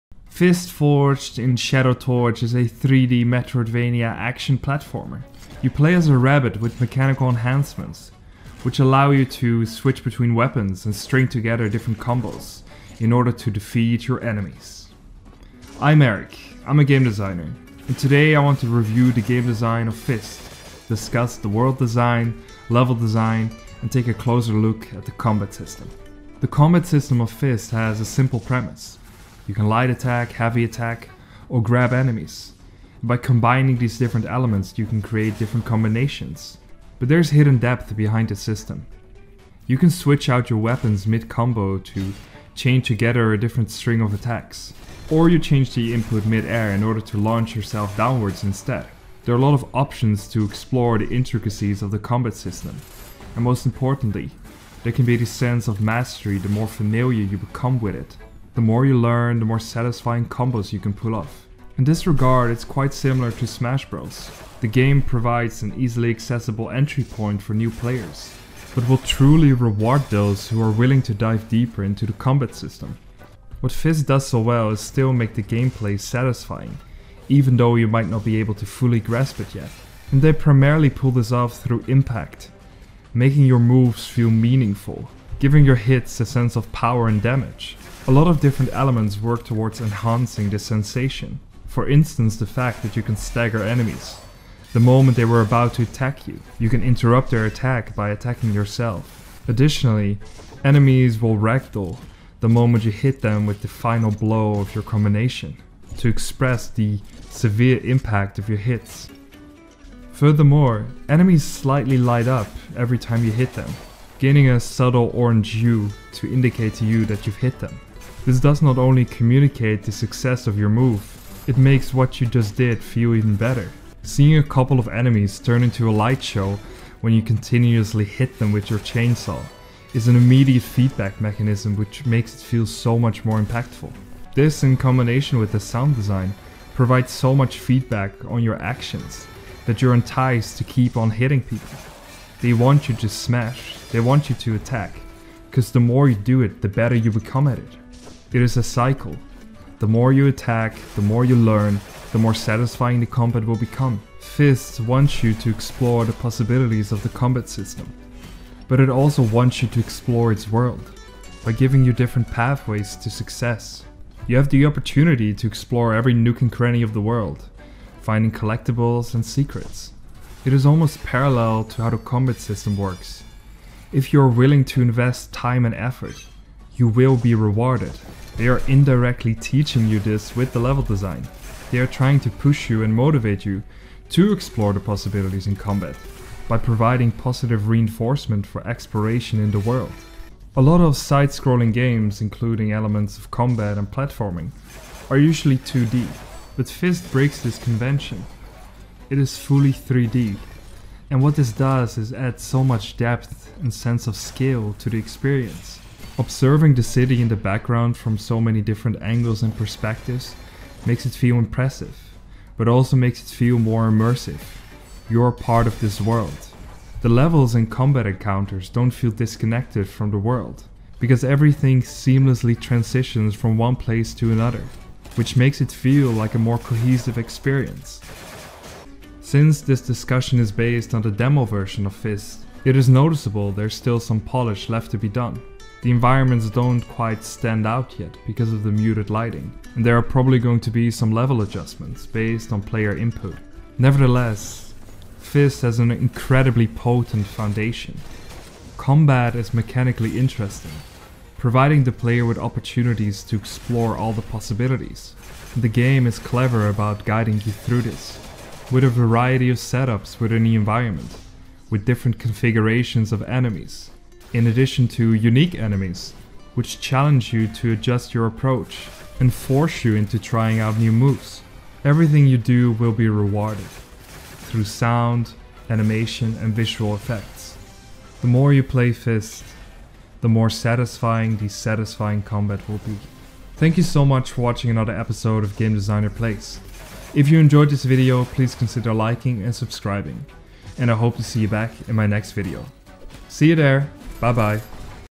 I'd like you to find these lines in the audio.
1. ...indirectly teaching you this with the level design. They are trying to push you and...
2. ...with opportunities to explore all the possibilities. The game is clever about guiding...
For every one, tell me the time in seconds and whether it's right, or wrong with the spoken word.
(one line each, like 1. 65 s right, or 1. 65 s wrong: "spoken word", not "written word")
1. 178 s right
2. 252 s right.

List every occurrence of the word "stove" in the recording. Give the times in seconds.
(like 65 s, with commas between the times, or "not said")
not said.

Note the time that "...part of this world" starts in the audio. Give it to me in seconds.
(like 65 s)
215 s.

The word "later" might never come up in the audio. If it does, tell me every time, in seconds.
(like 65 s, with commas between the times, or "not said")
not said.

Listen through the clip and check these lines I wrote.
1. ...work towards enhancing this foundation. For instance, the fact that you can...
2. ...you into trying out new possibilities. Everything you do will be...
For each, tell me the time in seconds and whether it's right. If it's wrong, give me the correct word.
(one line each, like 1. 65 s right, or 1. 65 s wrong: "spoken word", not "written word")
1. 89 s wrong: "sensation", not "foundation"
2. 269 s wrong: "moves", not "possibilities".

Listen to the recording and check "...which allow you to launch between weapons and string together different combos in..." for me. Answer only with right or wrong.
wrong.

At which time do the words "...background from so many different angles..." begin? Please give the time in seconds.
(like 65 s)
207 s.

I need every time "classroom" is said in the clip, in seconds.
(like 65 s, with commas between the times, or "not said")
not said.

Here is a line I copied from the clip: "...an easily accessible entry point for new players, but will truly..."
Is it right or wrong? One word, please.
right.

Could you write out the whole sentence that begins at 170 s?
It is almost parallel to how the combat system works.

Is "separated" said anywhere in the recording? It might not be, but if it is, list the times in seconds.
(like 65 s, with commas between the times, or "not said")
not said.